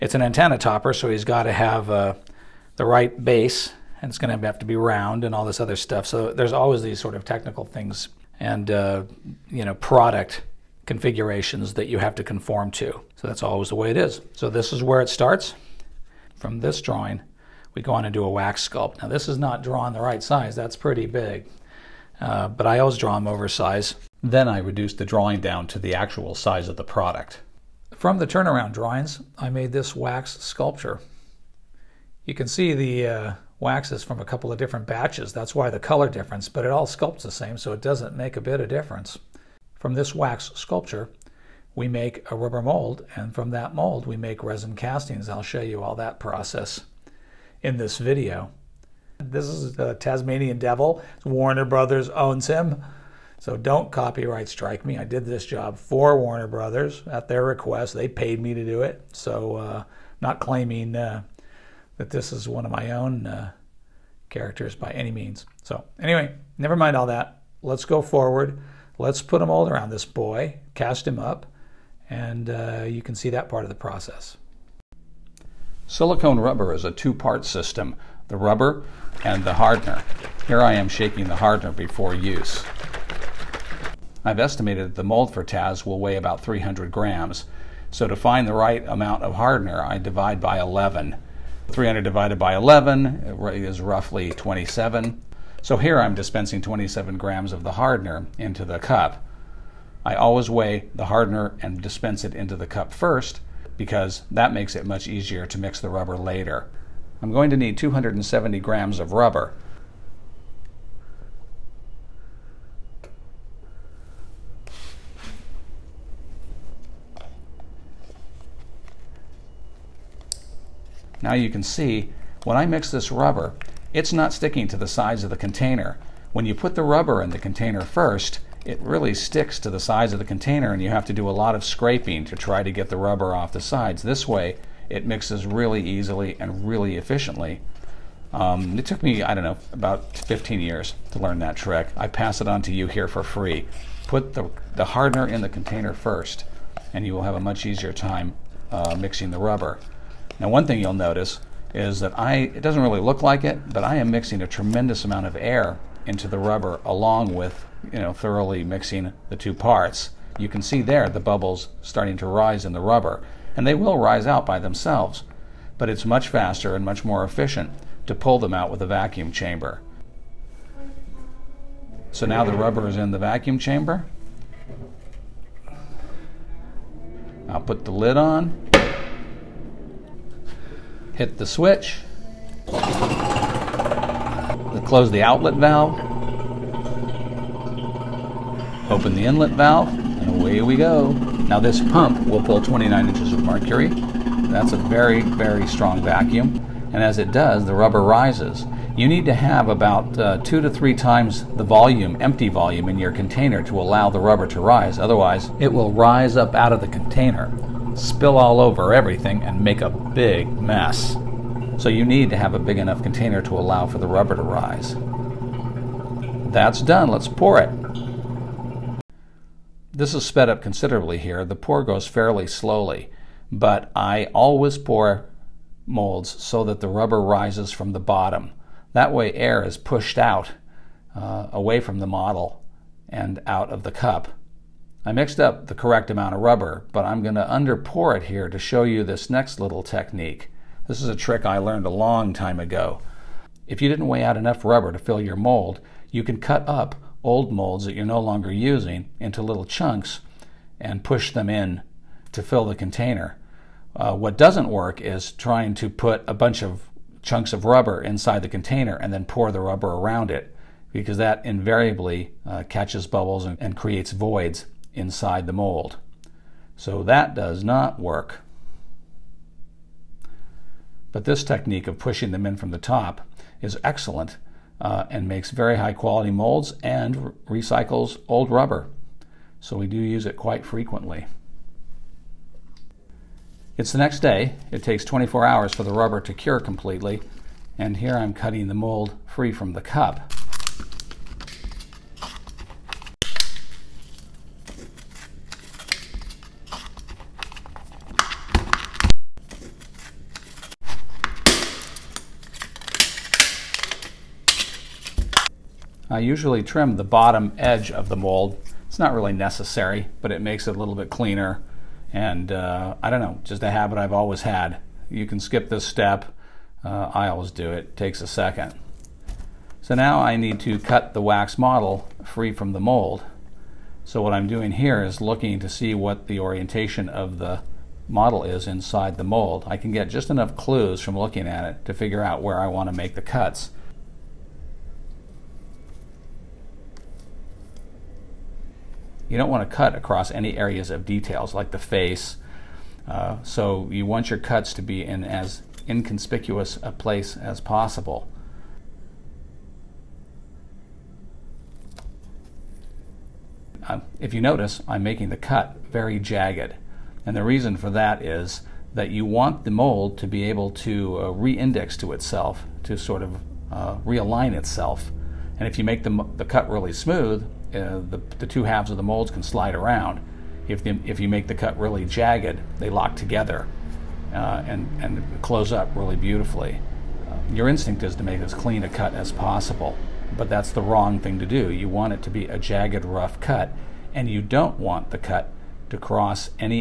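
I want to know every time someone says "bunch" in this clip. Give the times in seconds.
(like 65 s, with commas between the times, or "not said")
256 s.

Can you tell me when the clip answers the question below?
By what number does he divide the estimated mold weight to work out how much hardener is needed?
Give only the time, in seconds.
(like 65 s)
89 s.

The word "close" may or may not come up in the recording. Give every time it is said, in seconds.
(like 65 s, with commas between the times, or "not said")
184 s, 375 s.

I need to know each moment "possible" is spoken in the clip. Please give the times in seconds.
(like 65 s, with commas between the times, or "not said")
347 s, 379 s.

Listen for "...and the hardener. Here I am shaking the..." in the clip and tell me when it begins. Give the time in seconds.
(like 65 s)
79 s.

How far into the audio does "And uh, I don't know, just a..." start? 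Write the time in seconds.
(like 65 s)
312 s.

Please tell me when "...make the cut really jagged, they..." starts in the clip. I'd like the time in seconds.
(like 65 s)
371 s.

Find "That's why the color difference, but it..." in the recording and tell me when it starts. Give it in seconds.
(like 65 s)
35 s.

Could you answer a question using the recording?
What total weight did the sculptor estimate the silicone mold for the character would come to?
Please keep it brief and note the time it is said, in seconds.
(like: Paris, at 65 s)
300 grams, at 86 s.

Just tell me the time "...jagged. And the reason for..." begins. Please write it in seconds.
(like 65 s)
356 s.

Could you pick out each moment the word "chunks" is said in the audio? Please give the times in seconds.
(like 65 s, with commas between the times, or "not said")
249 s, 257 s.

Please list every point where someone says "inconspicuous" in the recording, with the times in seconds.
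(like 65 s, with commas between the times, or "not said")
345 s.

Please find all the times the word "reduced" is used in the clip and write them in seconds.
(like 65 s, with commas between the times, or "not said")
24 s.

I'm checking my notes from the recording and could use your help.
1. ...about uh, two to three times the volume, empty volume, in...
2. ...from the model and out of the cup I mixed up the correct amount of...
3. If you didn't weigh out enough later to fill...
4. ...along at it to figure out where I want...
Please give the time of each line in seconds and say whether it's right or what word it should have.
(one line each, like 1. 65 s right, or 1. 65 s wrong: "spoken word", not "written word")
1. 199 s right
2. 231 s right
3. 243 s wrong: "rubber", not "later"
4. 331 s wrong: "looking", not "along".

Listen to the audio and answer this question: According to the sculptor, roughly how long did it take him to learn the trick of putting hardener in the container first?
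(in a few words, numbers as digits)
15 years.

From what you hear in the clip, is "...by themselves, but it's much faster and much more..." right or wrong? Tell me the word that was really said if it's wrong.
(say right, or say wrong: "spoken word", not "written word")
right.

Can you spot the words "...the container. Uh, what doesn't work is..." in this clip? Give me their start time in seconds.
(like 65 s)
252 s.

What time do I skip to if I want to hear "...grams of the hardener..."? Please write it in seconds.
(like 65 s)
97 s.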